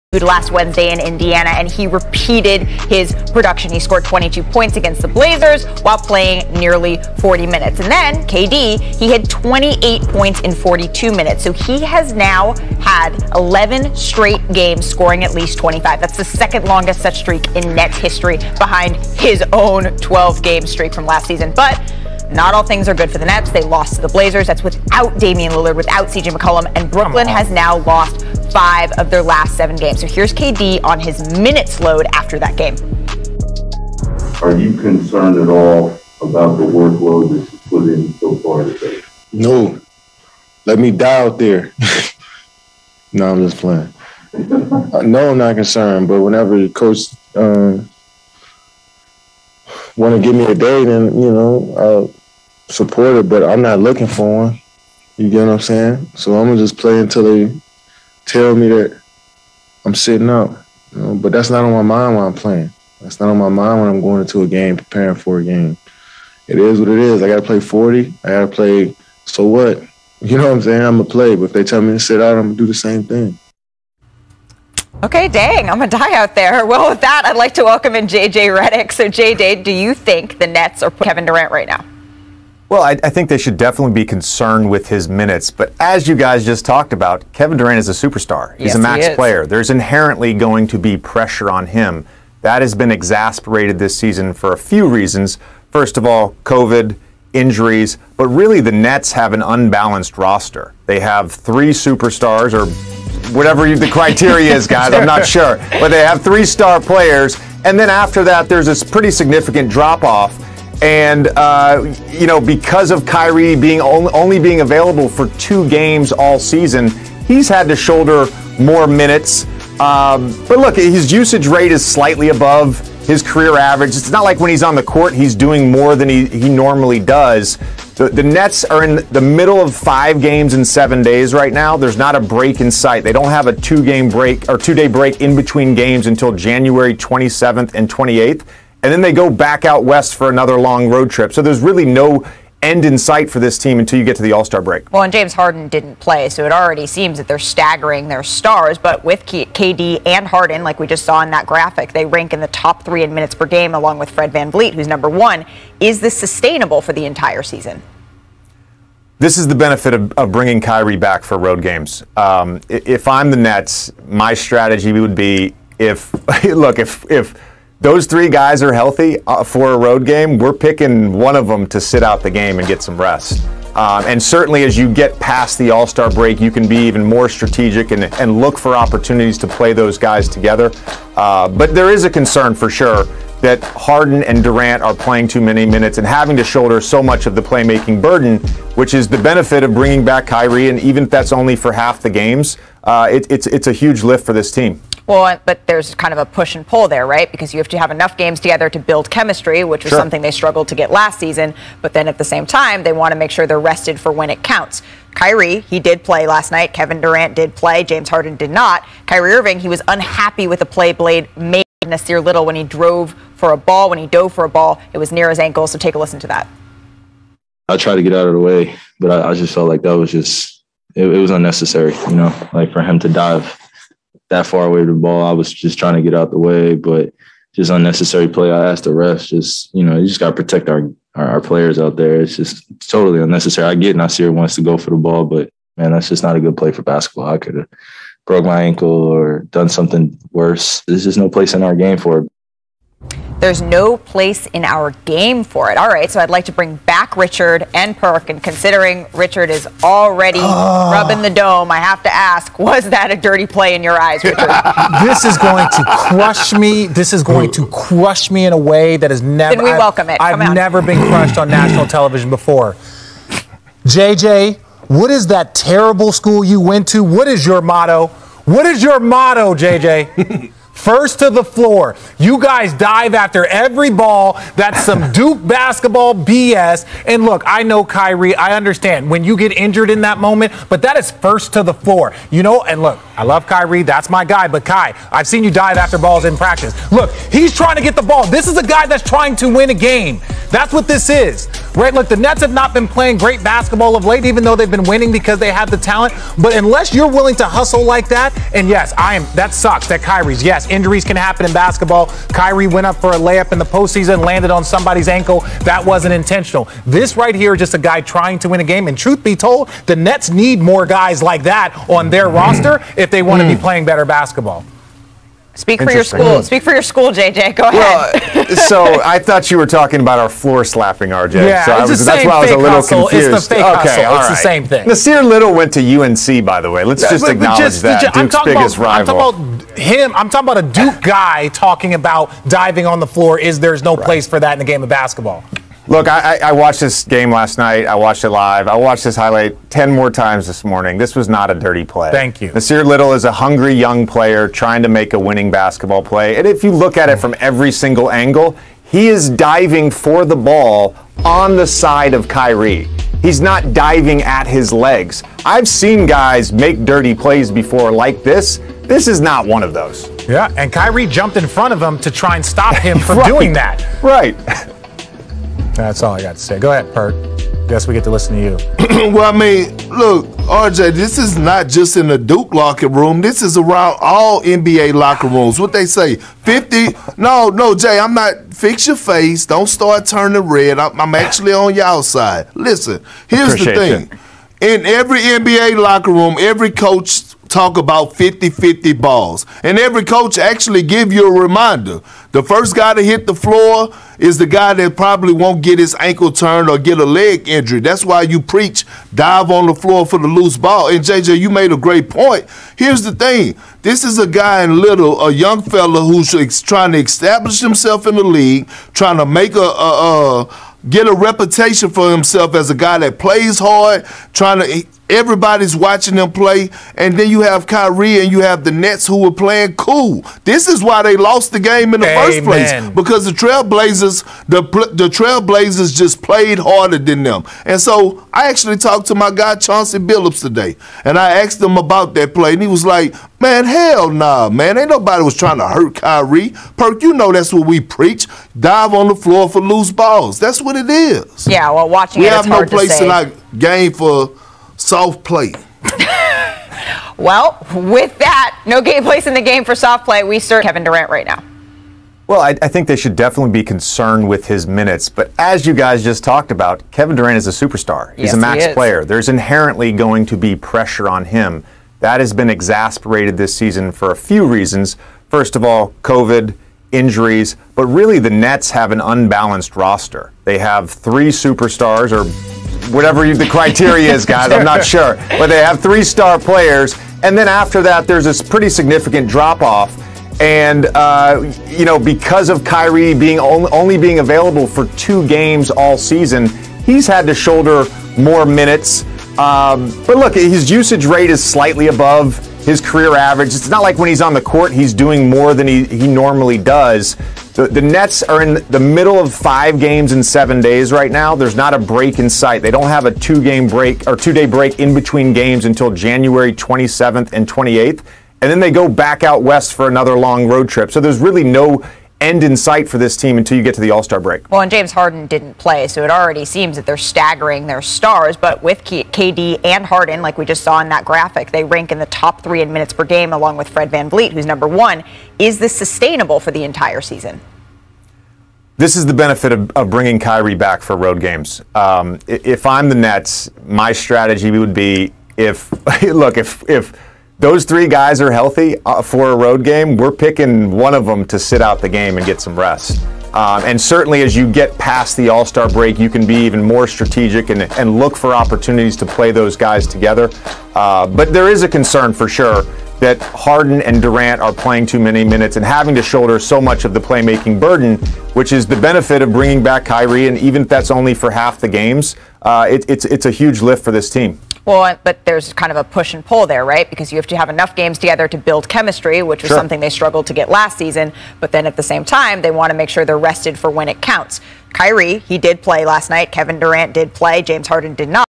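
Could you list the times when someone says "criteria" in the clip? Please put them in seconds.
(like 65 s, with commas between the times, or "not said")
103 s, 473 s.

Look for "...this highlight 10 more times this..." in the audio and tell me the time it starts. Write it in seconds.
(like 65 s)
339 s.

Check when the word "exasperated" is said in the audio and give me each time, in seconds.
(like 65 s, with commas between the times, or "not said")
92 s, 462 s.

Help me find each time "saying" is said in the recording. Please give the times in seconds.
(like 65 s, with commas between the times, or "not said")
55 s, 70 s.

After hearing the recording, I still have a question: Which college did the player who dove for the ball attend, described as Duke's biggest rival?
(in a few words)
UNC.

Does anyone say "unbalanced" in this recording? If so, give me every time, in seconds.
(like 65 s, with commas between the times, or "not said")
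99 s, 468 s.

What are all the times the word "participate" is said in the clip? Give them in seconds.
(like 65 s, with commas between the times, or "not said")
not said.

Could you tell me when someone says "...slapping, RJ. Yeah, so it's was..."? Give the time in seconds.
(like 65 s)
320 s.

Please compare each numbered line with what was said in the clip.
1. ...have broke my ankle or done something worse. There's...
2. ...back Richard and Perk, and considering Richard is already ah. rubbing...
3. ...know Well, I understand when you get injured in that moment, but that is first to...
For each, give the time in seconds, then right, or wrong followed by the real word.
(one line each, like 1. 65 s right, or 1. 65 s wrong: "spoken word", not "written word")
1. 237 s right
2. 246 s right
3. 277 s wrong: "Kyrie", not "Well".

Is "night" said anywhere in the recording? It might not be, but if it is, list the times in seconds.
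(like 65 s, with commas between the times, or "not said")
206 s, 337 s, 576 s.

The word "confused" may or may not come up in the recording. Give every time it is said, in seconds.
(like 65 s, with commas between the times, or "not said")
323 s.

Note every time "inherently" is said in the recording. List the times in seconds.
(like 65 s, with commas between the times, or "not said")
89 s, 459 s.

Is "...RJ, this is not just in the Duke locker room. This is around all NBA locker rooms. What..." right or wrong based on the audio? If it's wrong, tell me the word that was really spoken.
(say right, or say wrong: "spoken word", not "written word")
right.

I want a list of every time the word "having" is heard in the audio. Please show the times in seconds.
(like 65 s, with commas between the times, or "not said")
186 s, 555 s.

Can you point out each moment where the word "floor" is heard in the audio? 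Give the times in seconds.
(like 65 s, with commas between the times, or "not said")
271 s, 281 s, 320 s, 333 s, 393 s, 399 s, 439 s.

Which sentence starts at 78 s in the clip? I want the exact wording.
So, JJ, do you think the Nets are Kevin Durant right now?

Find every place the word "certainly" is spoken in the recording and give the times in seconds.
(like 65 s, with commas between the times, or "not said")
174 s, 543 s.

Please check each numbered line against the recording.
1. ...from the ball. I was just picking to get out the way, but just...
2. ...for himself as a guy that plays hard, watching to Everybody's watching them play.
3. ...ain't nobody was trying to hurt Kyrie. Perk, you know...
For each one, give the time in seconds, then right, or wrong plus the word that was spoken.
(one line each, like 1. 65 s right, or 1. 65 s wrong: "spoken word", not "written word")
1. 224 s wrong: "trying", not "picking"
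2. 411 s wrong: "trying", not "watching"
3. 434 s right.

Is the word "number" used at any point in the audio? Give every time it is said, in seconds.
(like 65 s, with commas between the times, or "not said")
154 s, 524 s.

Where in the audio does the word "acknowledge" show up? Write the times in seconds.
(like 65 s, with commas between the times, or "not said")
327 s.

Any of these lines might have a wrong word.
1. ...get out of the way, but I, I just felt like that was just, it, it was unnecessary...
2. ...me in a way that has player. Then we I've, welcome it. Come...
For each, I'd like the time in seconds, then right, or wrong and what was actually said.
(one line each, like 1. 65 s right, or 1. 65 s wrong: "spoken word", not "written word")
1. 218 s right
2. 258 s wrong: "never", not "player".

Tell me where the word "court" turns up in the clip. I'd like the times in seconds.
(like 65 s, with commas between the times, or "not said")
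124 s, 494 s.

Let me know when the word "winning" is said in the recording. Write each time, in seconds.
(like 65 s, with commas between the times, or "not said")
294 s, 345 s.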